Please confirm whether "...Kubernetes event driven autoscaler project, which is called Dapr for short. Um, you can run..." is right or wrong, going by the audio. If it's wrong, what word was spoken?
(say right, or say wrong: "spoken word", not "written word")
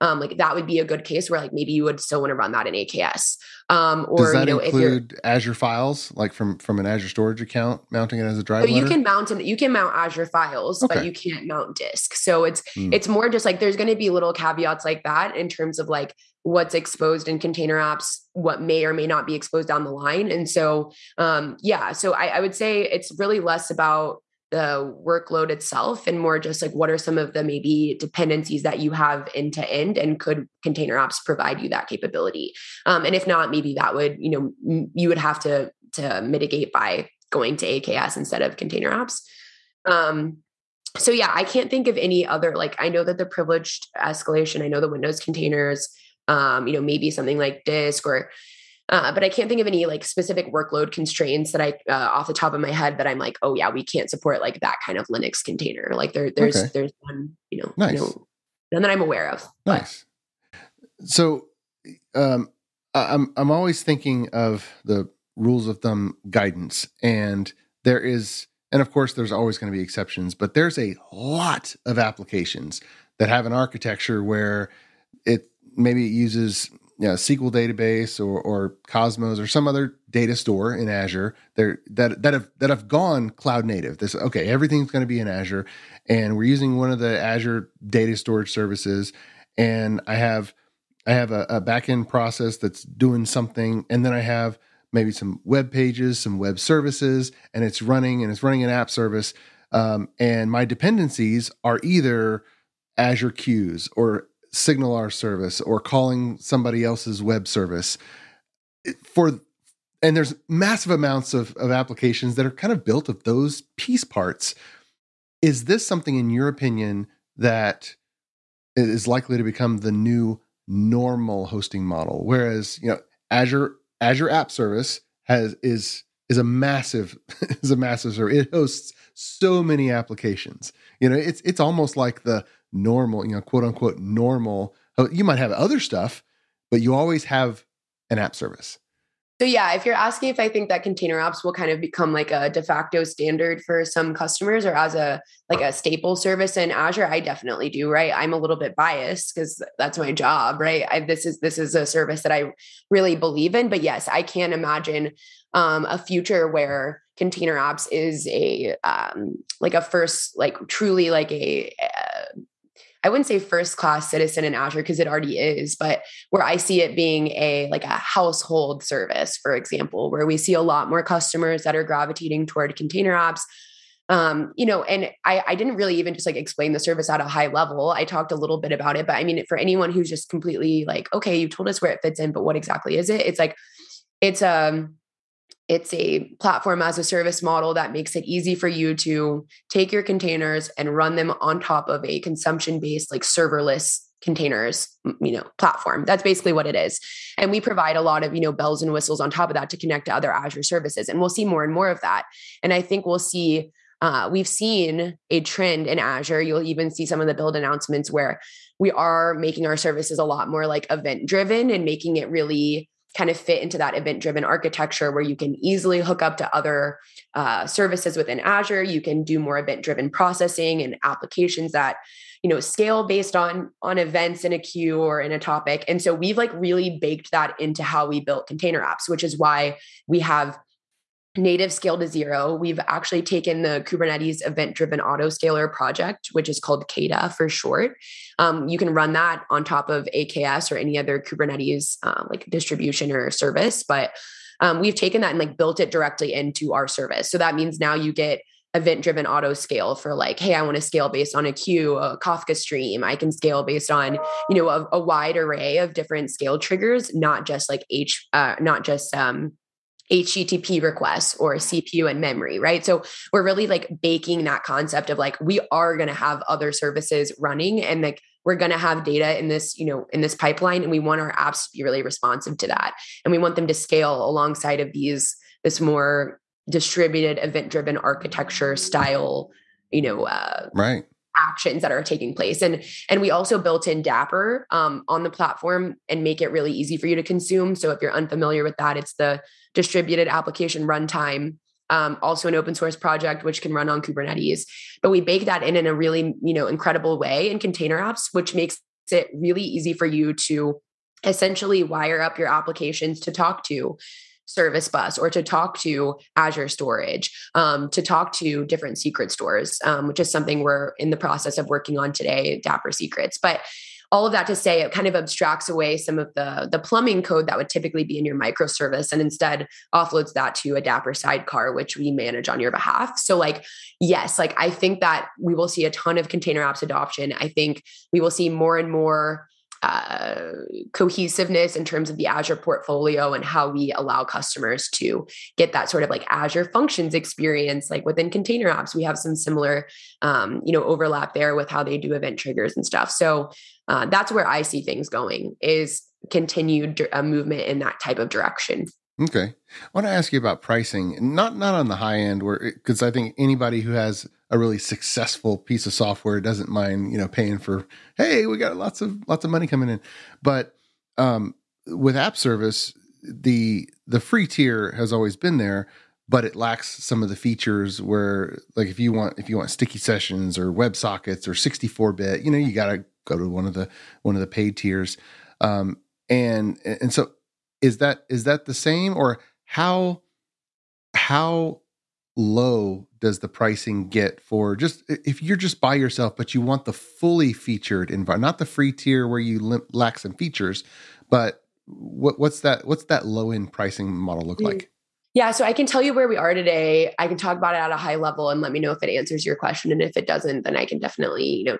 wrong: "KEDA", not "Dapr".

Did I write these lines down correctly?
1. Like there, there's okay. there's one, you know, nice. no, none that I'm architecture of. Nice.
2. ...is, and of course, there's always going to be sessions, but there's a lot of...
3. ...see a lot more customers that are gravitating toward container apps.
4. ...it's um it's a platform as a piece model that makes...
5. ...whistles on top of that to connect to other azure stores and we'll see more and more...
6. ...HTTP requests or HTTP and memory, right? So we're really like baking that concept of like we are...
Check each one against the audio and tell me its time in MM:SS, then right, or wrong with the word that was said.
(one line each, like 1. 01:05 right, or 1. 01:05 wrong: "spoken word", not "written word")
1. 00:55 wrong: "aware", not "architecture"
2. 01:08 wrong: "exceptions", not "sessions"
3. 02:50 right
4. 03:04 wrong: "service", not "piece"
5. 03:18 wrong: "services", not "stores"
6. 04:20 wrong: "CPU", not "HTTP".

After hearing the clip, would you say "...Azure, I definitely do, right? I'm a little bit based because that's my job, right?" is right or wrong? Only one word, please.
wrong.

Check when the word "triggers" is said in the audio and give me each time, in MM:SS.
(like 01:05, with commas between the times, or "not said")
04:16, 05:42.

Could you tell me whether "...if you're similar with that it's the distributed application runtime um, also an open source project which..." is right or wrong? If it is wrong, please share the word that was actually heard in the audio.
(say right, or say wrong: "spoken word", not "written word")
wrong: "unfamiliar", not "similar".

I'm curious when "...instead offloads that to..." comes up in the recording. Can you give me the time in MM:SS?
05:19.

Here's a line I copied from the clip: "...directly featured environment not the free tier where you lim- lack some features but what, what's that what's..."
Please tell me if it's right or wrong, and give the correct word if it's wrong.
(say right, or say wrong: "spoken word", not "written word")
wrong: "fully", not "directly".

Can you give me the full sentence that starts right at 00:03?
Um, or Does that you know, include Azure files, like from from an Azure storage account, mounting it as a drive?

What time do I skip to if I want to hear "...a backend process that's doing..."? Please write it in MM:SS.
01:31.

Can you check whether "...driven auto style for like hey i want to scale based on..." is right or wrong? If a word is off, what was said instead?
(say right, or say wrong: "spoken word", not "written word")
wrong: "scale", not "style".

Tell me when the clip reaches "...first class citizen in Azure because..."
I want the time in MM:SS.
02:43.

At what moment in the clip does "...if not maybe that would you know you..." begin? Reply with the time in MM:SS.
00:33.